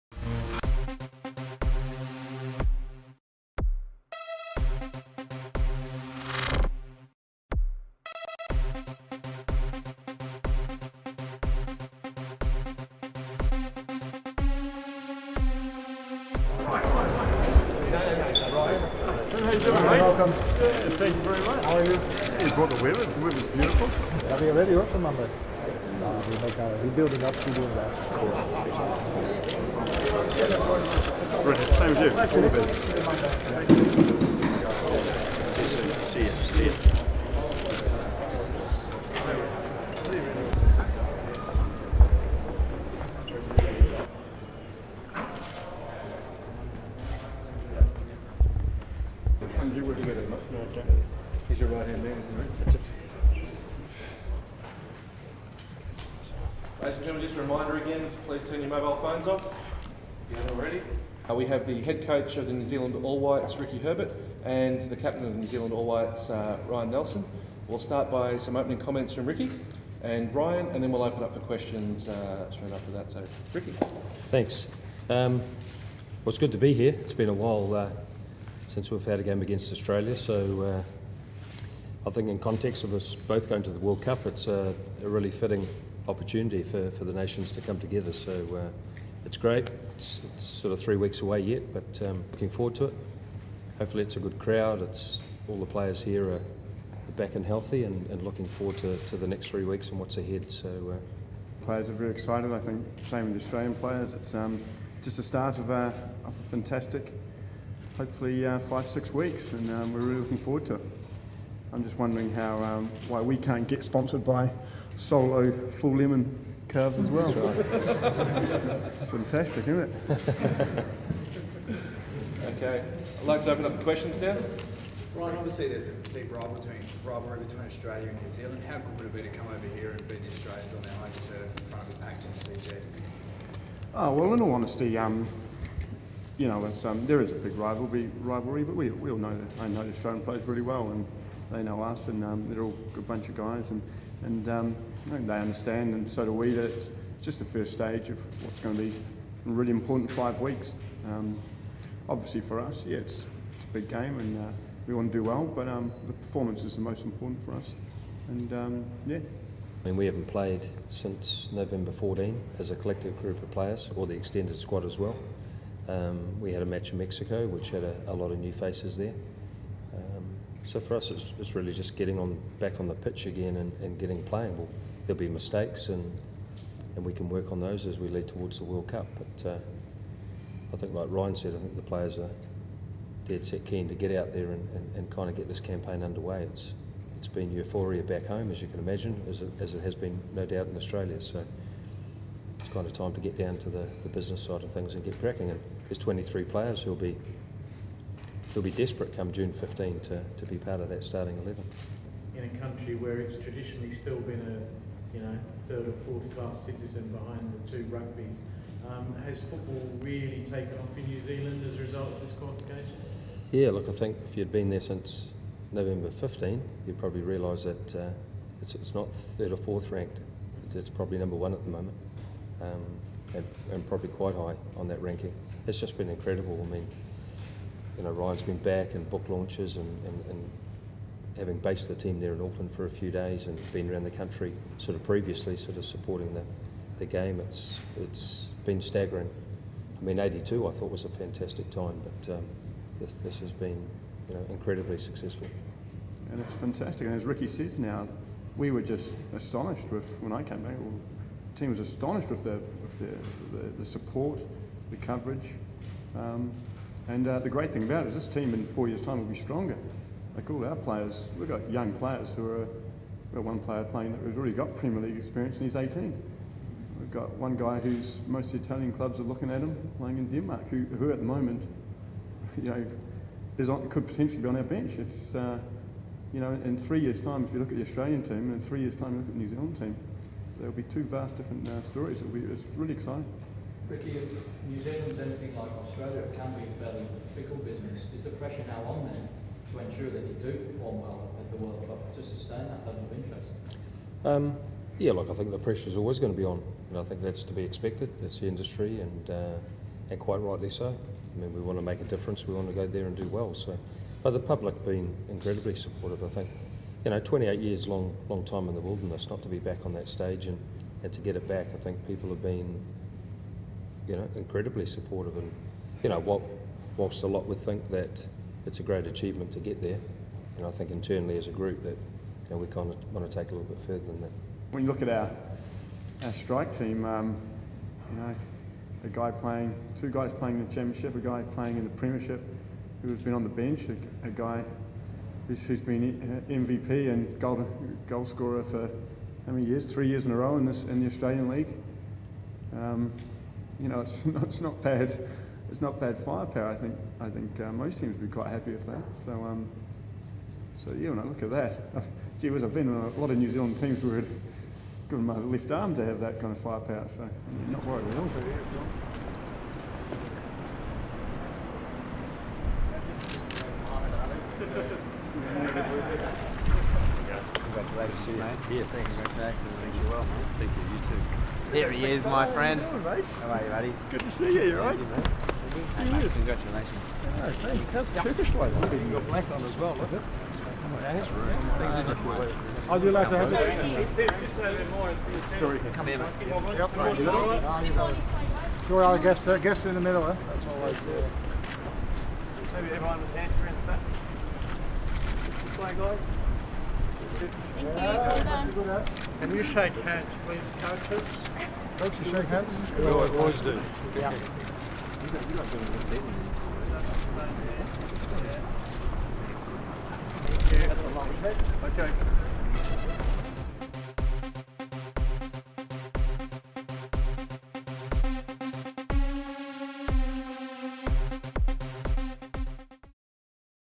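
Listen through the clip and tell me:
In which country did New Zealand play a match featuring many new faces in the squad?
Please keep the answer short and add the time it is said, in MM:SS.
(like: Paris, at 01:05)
Mexico, at 02:46.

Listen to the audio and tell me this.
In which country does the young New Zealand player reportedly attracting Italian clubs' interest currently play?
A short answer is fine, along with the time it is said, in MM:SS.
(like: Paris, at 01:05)
Denmark, at 04:30.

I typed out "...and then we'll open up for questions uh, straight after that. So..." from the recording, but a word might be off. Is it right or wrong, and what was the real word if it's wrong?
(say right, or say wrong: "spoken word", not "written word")
right.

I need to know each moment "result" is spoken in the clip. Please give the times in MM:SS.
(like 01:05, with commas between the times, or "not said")
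03:31.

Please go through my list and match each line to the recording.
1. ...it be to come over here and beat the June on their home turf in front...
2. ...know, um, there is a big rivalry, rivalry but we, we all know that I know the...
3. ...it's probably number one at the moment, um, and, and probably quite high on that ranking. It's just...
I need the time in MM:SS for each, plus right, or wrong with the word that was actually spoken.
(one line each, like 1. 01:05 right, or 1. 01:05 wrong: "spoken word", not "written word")
1. 02:09 wrong: "Australians", not "June"
2. 02:16 right
3. 03:40 right.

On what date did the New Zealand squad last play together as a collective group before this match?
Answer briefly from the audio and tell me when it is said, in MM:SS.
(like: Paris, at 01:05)
November 14, at 02:41.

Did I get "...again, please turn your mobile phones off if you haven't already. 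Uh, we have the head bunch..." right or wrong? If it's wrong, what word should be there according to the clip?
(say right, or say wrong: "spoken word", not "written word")
wrong: "coach", not "bunch".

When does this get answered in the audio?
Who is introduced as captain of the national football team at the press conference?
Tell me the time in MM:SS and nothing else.
01:06.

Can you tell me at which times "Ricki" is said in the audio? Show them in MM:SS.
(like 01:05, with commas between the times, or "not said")
01:03, 01:09, 01:13, 04:07, 04:43.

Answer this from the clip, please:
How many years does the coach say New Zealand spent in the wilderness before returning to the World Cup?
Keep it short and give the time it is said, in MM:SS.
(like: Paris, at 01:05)
28, at 05:07.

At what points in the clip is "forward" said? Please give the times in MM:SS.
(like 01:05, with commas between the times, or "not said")
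01:32, 01:38, 01:50.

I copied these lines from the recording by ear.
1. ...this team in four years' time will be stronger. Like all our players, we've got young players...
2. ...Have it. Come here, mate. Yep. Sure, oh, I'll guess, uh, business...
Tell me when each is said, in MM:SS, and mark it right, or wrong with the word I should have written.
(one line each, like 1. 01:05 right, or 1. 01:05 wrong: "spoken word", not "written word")
1. 04:18 right
2. 06:23 wrong: "guess", not "business".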